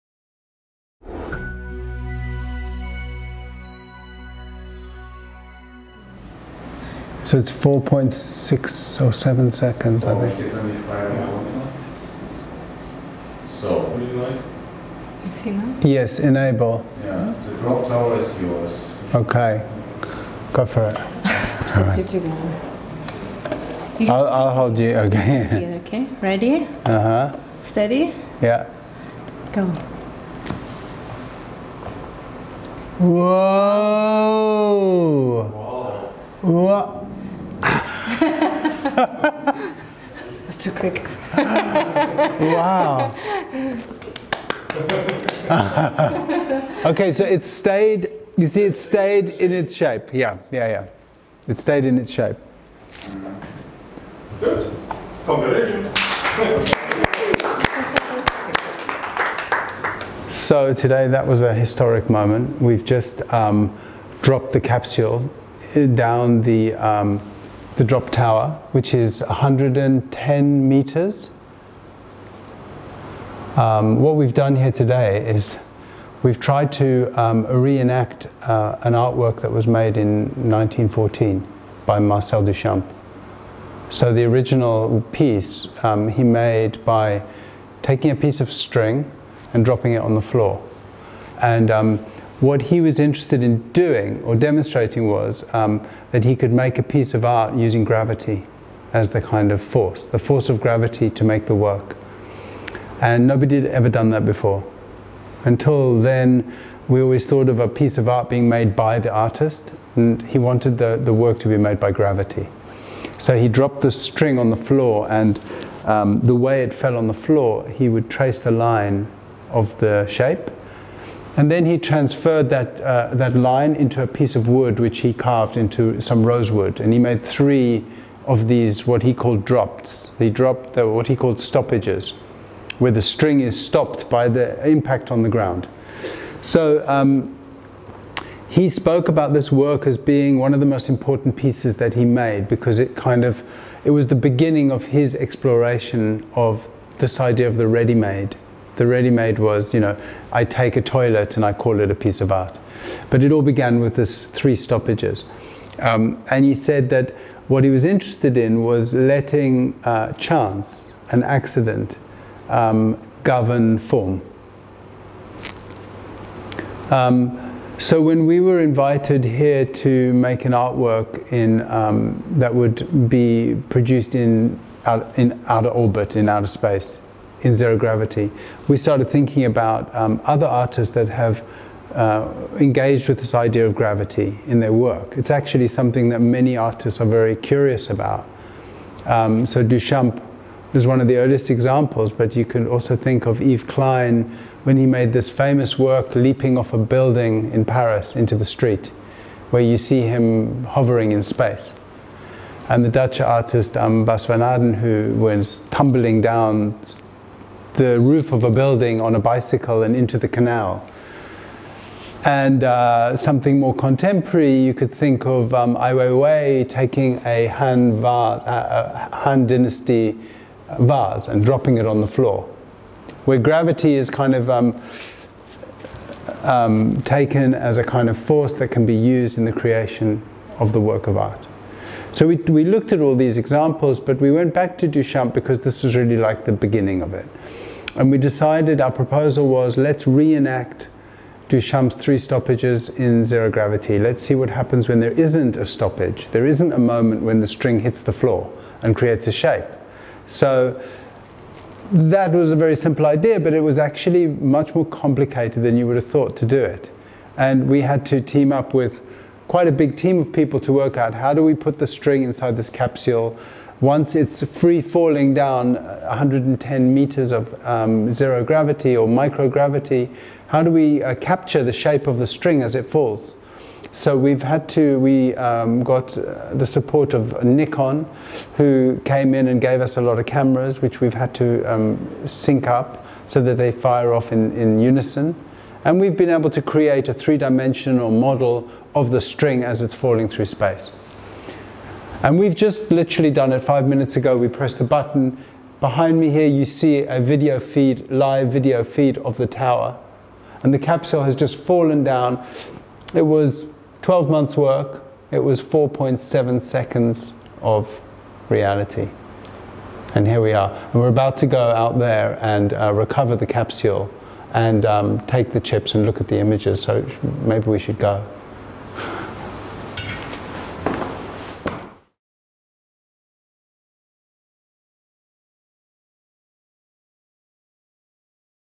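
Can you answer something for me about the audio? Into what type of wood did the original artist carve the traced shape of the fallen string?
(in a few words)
rosewood.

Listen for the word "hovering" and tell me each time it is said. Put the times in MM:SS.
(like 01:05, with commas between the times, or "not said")
03:20.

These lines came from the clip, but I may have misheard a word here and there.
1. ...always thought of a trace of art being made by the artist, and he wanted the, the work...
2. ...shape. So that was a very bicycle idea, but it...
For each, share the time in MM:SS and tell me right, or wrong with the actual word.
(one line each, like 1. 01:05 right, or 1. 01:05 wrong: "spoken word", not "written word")
1. 01:46 wrong: "piece", not "trace"
2. 04:09 wrong: "simple", not "bicycle".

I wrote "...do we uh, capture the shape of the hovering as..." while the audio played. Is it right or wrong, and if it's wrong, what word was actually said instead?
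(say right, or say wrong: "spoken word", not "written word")
wrong: "string", not "hovering".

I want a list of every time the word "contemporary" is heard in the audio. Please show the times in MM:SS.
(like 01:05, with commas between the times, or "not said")
03:33.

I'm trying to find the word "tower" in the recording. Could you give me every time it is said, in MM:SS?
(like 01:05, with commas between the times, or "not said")
00:17, 01:08, 04:59.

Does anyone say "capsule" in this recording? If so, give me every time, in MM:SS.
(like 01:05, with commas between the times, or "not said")
01:04, 04:22, 05:00, 05:13.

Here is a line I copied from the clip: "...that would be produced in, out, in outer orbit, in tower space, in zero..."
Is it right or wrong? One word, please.
wrong.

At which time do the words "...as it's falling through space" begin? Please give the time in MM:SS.
04:49.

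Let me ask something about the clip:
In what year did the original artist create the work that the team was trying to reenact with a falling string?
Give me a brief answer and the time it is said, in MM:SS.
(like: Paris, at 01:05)
1914, at 01:20.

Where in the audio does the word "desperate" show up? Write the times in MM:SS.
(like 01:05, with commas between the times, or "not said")
not said.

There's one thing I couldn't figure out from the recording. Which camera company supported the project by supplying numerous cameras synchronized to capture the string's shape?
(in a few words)
Nikon.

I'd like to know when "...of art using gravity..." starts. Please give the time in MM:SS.
01:37.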